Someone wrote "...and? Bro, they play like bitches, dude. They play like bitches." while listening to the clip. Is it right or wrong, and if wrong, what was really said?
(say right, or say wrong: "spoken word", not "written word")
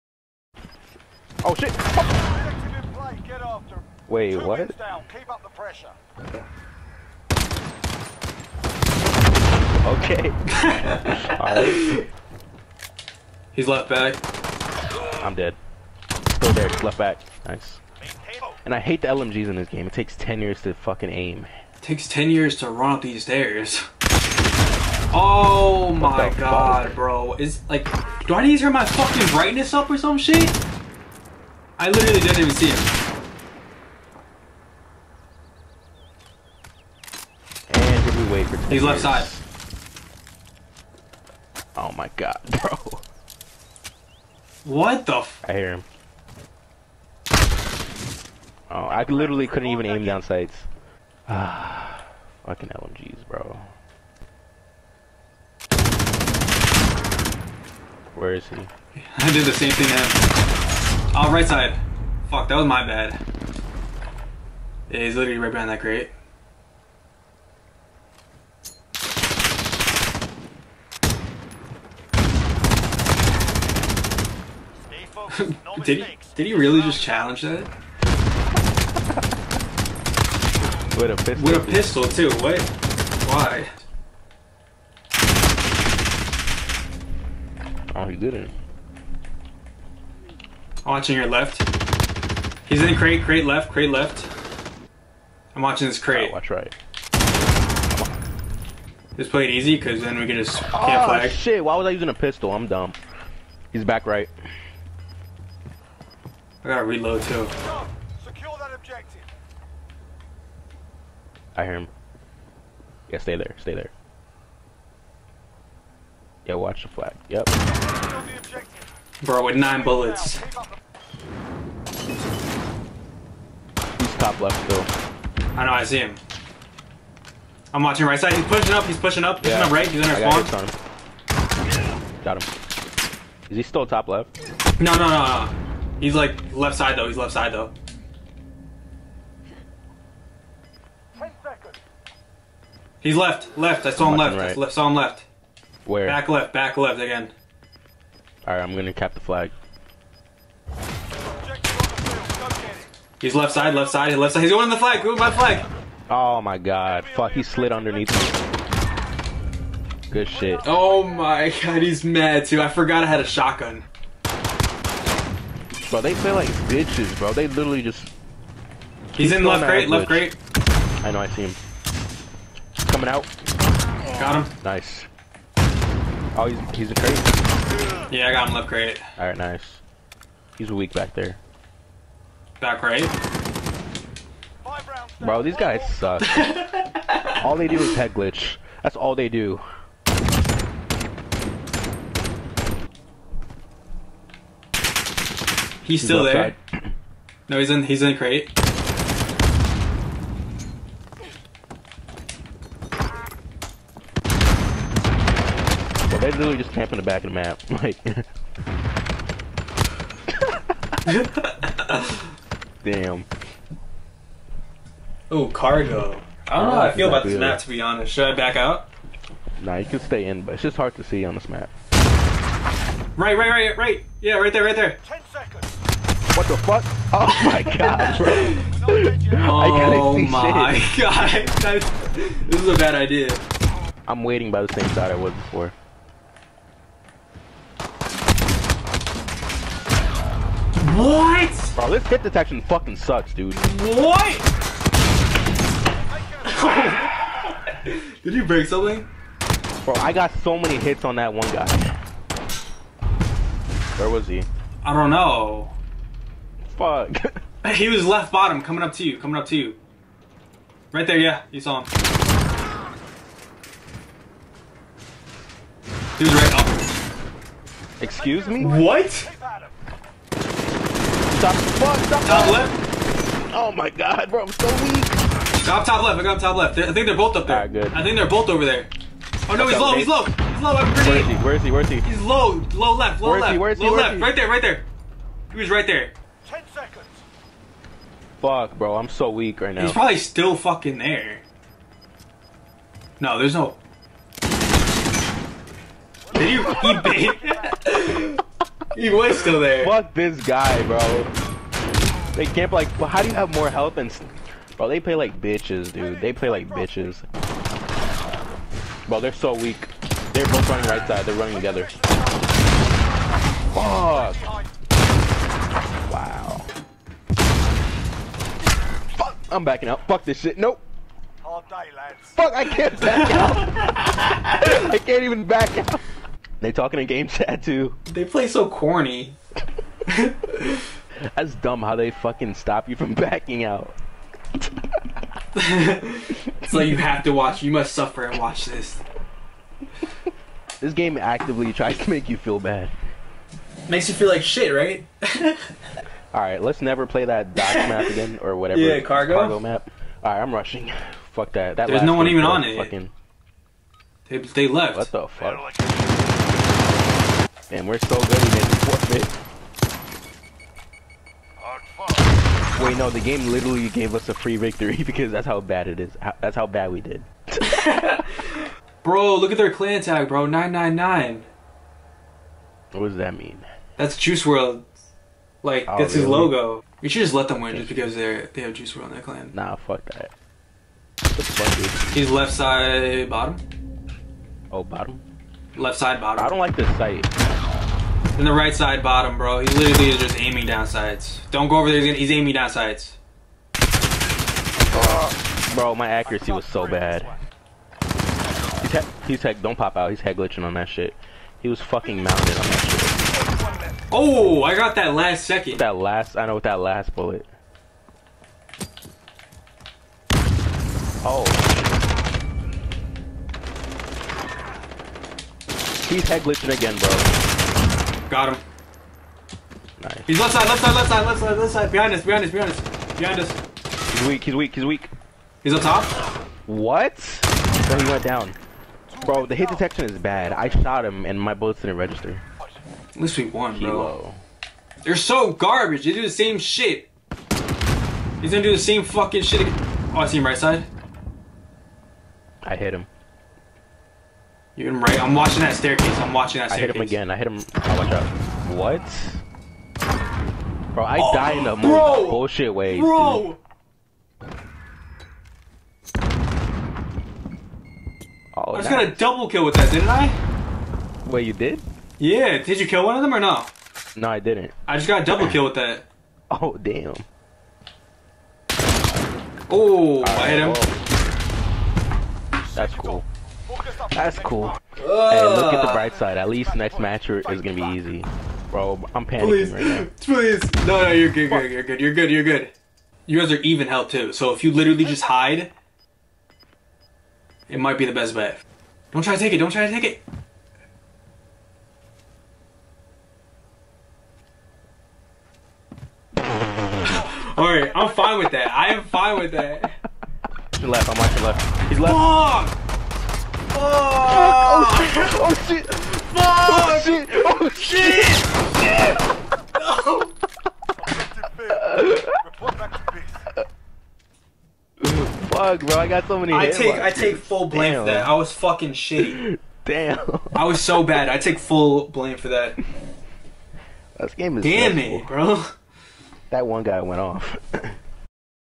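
right.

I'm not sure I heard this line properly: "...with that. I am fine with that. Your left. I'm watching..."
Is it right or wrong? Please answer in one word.
right.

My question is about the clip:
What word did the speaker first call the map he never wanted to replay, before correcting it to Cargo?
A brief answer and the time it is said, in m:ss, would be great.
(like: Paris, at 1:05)
dock, at 5:47.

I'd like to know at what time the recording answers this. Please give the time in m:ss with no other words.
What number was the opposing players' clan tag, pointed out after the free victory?
6:10.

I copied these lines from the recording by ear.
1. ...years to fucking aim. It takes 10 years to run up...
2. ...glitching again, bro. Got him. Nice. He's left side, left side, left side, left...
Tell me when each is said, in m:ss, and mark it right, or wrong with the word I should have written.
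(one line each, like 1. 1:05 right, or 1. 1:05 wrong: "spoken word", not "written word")
1. 0:20 right
2. 6:56 right.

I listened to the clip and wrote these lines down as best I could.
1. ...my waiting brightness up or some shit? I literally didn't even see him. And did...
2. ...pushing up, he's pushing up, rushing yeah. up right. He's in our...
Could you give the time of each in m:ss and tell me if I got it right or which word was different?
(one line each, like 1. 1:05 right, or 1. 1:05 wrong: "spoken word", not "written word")
1. 0:28 wrong: "fucking", not "waiting"
2. 2:08 wrong: "pushing", not "rushing".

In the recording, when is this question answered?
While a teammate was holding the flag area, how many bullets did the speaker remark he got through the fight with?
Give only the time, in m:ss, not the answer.
1:59.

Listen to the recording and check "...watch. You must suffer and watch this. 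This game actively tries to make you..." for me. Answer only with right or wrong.
right.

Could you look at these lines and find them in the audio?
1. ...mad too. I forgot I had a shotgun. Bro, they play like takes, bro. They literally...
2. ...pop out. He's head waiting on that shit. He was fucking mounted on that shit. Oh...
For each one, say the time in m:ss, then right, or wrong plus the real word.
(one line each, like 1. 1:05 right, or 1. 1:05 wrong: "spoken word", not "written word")
1. 2:42 wrong: "bitches", not "takes"
2. 6:39 wrong: "glitching", not "waiting".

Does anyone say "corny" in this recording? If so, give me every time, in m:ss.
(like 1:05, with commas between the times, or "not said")
5:28.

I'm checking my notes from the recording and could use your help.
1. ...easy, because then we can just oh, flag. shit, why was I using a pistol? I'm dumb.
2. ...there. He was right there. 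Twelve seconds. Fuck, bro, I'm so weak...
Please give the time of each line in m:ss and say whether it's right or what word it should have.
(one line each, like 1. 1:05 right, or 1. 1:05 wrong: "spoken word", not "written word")
1. 1:39 right
2. 4:44 wrong: "Ten", not "Twelve".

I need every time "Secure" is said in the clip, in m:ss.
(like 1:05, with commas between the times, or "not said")
1:48.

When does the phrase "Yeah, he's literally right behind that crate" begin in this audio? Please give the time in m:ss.
1:04.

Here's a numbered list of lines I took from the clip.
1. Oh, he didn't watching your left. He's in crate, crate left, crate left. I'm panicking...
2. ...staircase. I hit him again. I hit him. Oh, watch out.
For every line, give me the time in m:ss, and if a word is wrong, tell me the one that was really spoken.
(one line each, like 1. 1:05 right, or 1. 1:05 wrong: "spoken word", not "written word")
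1. 1:28 wrong: "watching", not "panicking"
2. 7:26 right.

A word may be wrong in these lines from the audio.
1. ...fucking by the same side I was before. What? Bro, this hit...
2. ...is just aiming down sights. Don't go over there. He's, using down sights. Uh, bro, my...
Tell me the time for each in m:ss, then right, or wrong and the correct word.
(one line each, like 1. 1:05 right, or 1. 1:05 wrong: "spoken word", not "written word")
1. 3:54 wrong: "waiting", not "fucking"
2. 6:30 wrong: "aiming", not "using".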